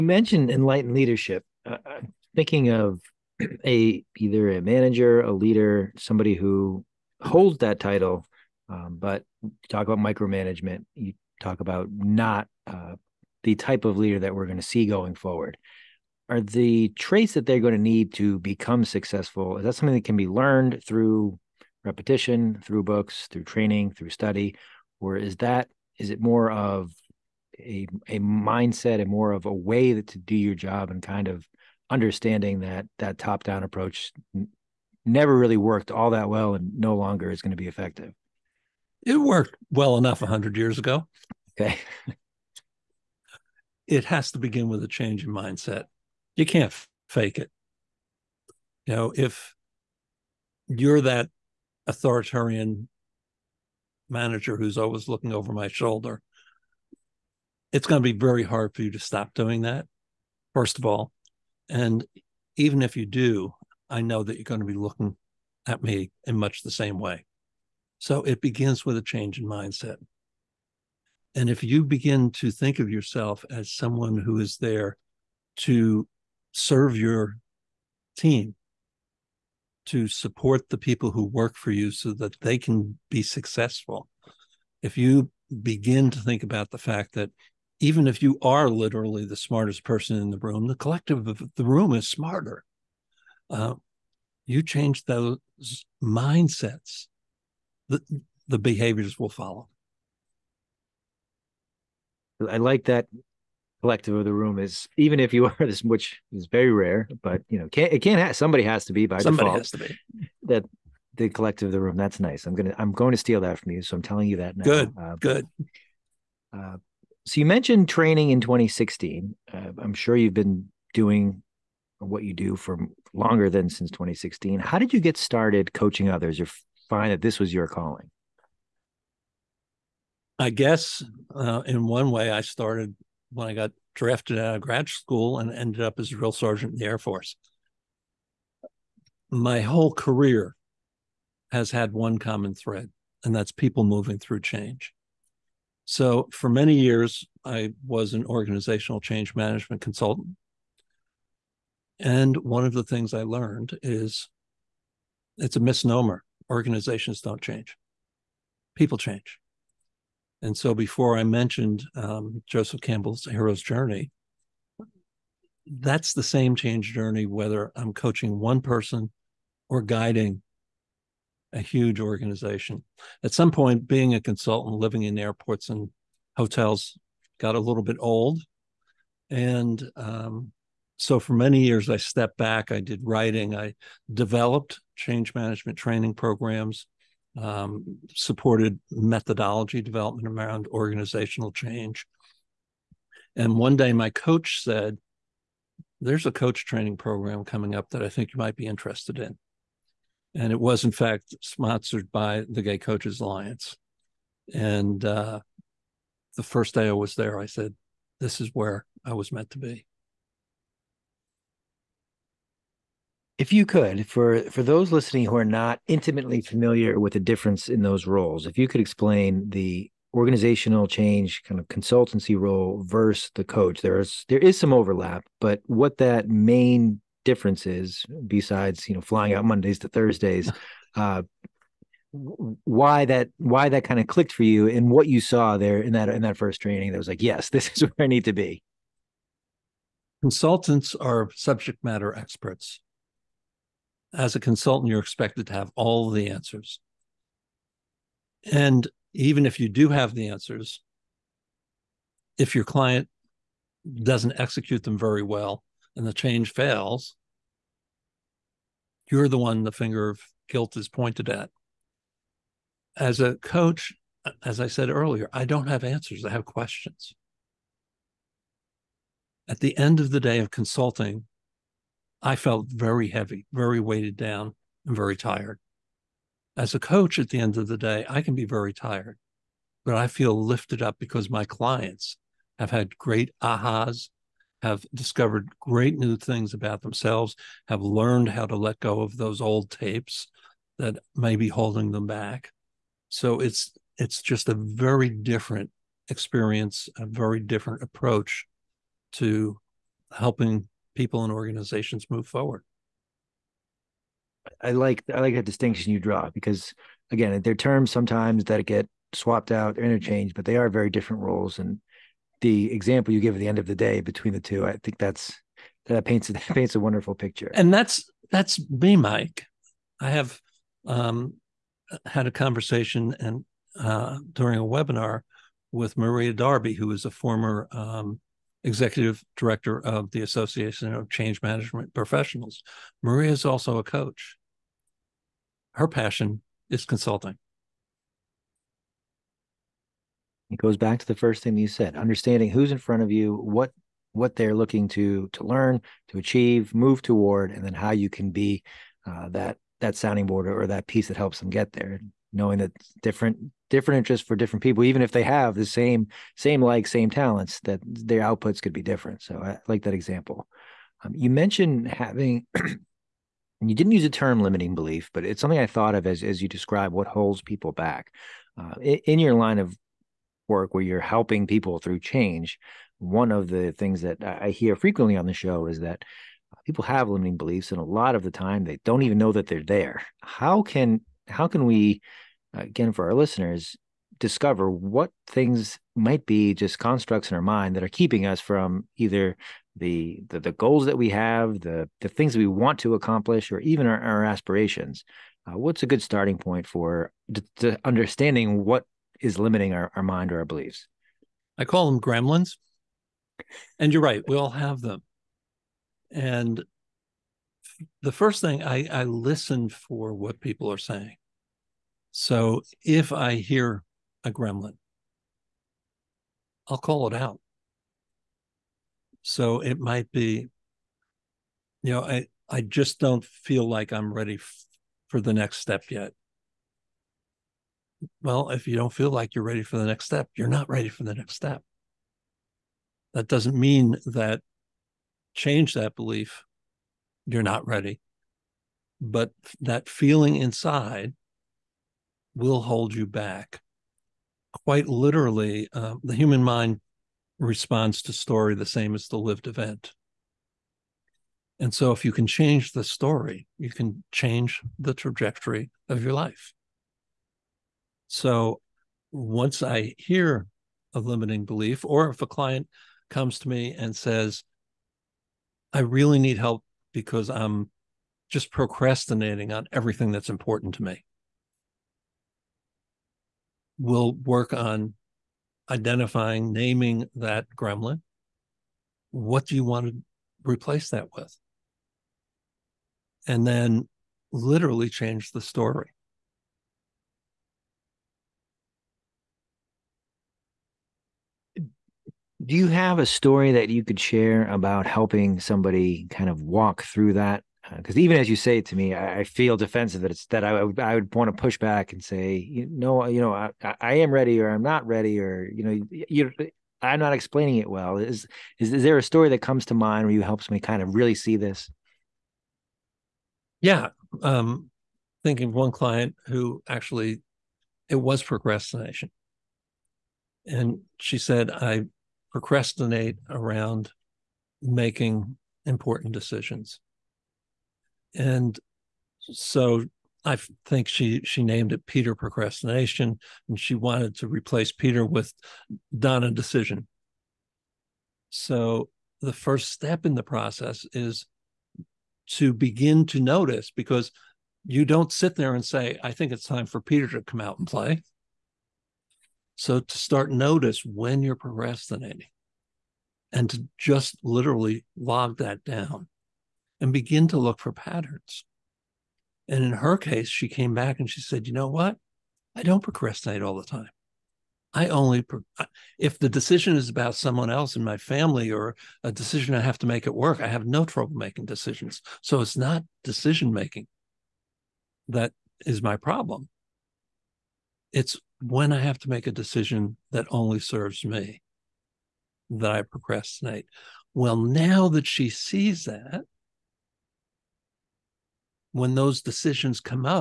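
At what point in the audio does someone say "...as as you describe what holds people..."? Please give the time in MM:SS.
06:06.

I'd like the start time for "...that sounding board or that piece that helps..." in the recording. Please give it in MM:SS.
05:49.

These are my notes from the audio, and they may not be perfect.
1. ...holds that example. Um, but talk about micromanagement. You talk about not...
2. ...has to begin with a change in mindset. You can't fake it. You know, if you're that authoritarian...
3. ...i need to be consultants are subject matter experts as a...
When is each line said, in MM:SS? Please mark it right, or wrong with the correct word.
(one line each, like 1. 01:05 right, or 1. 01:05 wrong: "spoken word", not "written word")
1. 00:07 wrong: "title", not "example"
2. 00:44 right
3. 03:58 right.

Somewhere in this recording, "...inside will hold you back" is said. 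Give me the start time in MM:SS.
07:20.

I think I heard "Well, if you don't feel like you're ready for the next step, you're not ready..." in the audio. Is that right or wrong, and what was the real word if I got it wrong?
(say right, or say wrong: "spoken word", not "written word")
right.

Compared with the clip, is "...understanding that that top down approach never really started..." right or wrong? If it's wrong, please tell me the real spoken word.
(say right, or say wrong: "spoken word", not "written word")
wrong: "worked", not "started".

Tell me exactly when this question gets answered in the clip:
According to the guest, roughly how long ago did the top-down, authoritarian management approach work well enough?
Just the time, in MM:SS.
00:40.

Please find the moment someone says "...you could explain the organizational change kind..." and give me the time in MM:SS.
03:38.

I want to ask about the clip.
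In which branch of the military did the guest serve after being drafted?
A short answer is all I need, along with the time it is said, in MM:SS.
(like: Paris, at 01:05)
Air Force, at 02:16.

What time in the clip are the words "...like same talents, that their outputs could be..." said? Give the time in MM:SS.
05:56.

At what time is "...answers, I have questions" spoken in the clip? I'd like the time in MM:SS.
04:25.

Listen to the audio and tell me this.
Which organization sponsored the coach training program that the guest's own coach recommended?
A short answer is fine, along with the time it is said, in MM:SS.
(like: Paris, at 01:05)
Gay Coaches Alliance, at 03:22.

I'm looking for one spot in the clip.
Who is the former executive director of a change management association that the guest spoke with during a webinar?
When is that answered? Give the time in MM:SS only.
05:25.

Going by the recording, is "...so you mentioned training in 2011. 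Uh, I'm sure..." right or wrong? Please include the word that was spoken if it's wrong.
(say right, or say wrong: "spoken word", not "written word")
wrong: "2016", not "2011".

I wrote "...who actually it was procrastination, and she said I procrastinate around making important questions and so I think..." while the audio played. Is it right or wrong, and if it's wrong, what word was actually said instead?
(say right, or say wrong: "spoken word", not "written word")
wrong: "decisions", not "questions".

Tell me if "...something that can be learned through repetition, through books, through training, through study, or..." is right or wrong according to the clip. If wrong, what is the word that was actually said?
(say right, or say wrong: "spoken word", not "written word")
right.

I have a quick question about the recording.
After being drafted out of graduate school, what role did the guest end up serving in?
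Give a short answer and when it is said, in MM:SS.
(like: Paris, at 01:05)
Drill sergeant, at 02:16.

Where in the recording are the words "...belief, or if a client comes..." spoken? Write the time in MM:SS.
07:41.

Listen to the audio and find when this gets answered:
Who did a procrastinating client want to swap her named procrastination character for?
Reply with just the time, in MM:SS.
08:55.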